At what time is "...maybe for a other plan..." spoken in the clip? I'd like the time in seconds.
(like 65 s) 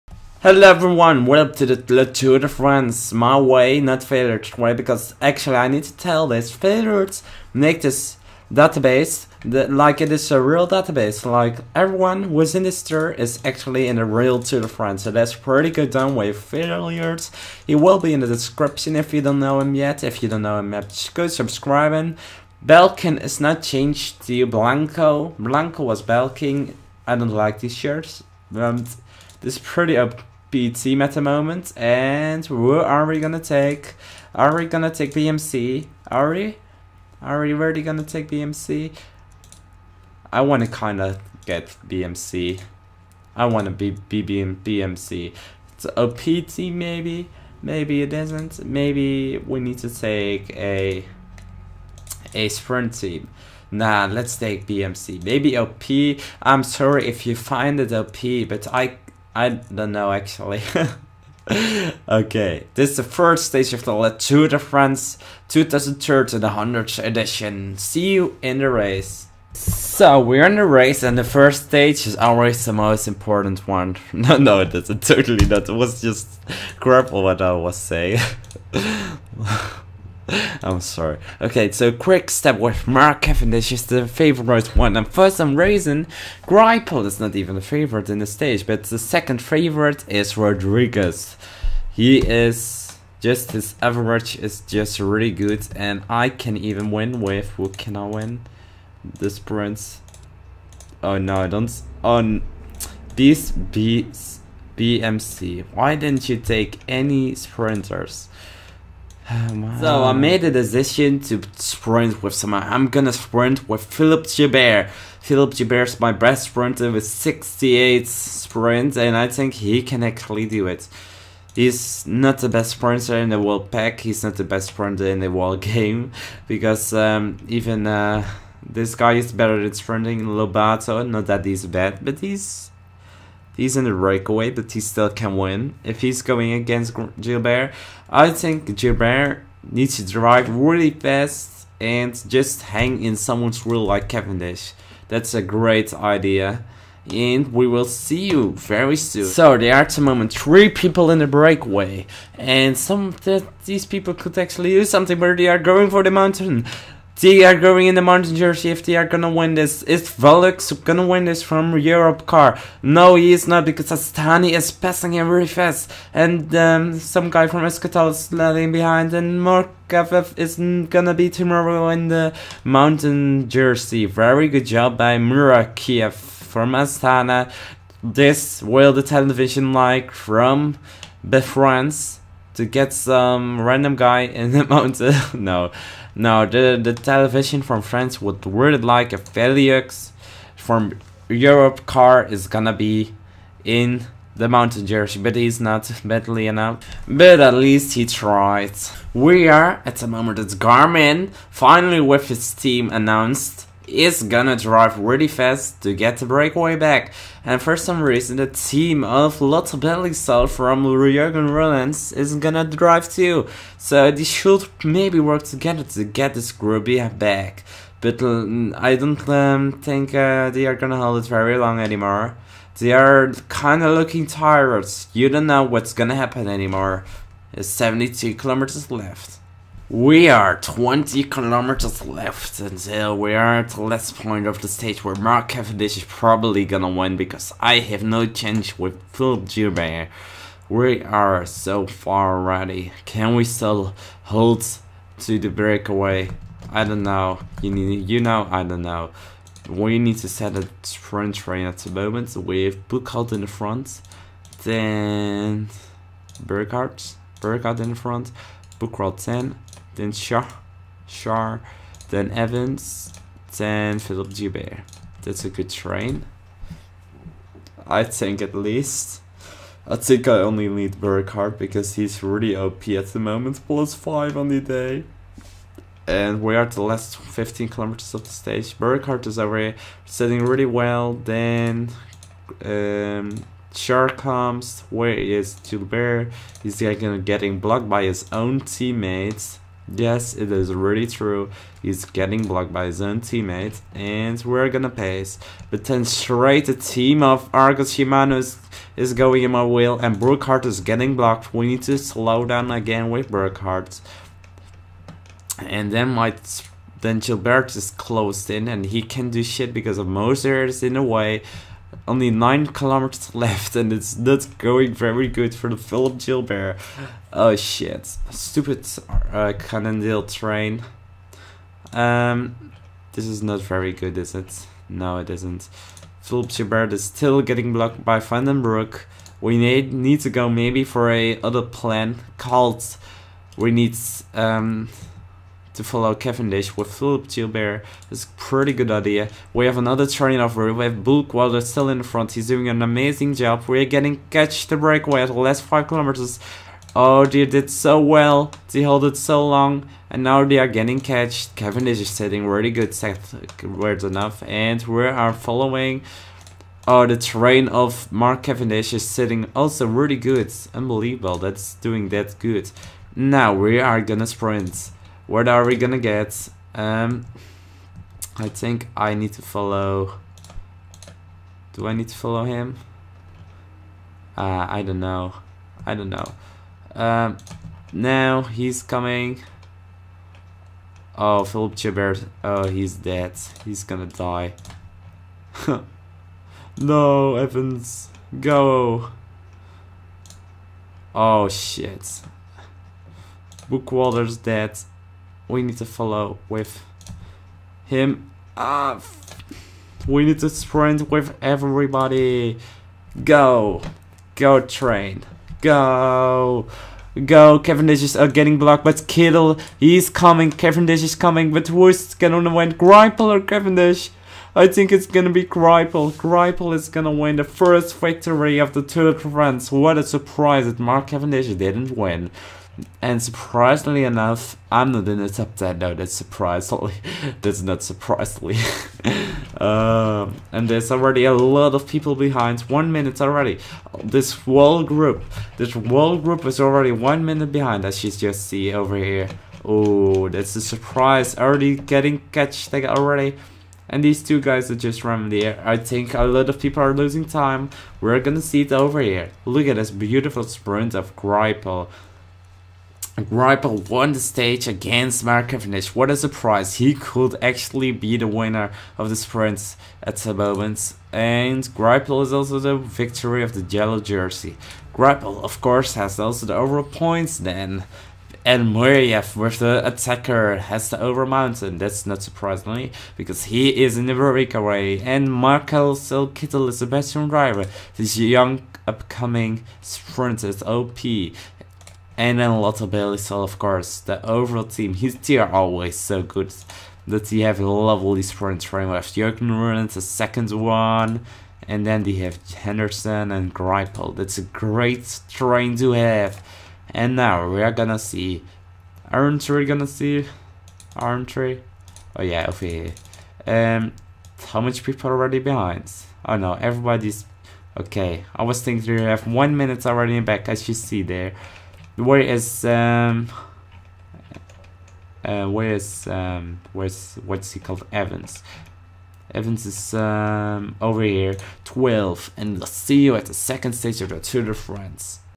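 330 s.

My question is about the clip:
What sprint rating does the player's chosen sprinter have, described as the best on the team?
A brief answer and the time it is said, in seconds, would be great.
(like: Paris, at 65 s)
68, at 117 s.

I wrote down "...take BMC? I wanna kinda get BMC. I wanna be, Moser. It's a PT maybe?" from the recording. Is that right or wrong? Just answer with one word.
wrong.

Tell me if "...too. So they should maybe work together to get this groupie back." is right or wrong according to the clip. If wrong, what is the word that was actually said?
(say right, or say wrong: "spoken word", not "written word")
right.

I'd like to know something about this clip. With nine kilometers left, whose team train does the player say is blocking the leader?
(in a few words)
Moser.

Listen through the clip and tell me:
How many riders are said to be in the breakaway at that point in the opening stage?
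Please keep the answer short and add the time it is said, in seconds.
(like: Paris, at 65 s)
3, at 150 s.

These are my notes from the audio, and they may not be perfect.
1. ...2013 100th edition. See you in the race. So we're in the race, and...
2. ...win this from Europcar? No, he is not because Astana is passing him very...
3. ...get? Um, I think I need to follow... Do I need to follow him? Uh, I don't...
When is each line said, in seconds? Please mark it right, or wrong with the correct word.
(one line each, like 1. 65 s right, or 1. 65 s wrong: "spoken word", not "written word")
1. 65 s right
2. 161 s right
3. 365 s right.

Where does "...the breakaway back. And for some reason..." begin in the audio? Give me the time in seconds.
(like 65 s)
206 s.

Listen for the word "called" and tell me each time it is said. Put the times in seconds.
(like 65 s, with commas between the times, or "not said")
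332 s, 517 s.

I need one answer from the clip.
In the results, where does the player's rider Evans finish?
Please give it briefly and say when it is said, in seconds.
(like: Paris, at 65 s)
12, at 521 s.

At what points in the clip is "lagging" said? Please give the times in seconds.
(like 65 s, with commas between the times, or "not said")
168 s.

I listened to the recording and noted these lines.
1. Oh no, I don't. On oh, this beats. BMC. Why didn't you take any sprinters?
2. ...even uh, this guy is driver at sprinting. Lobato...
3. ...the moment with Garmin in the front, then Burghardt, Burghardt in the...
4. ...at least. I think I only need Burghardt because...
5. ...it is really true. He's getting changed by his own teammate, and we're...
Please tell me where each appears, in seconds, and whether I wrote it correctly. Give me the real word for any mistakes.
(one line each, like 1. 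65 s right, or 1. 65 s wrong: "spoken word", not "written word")
1. 101 s right
2. 127 s wrong: "better", not "driver"
3. 251 s wrong: "Buchholz", not "Garmin"
4. 268 s right
5. 290 s wrong: "blocked", not "changed".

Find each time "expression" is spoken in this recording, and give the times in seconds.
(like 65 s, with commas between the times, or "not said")
not said.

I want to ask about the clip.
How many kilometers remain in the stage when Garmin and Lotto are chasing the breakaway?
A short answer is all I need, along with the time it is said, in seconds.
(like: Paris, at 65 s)
72, at 227 s.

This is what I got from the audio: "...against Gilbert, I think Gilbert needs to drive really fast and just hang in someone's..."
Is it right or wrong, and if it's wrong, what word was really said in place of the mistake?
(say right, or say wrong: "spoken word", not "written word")
right.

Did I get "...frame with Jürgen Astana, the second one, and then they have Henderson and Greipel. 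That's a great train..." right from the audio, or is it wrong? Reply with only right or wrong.
wrong.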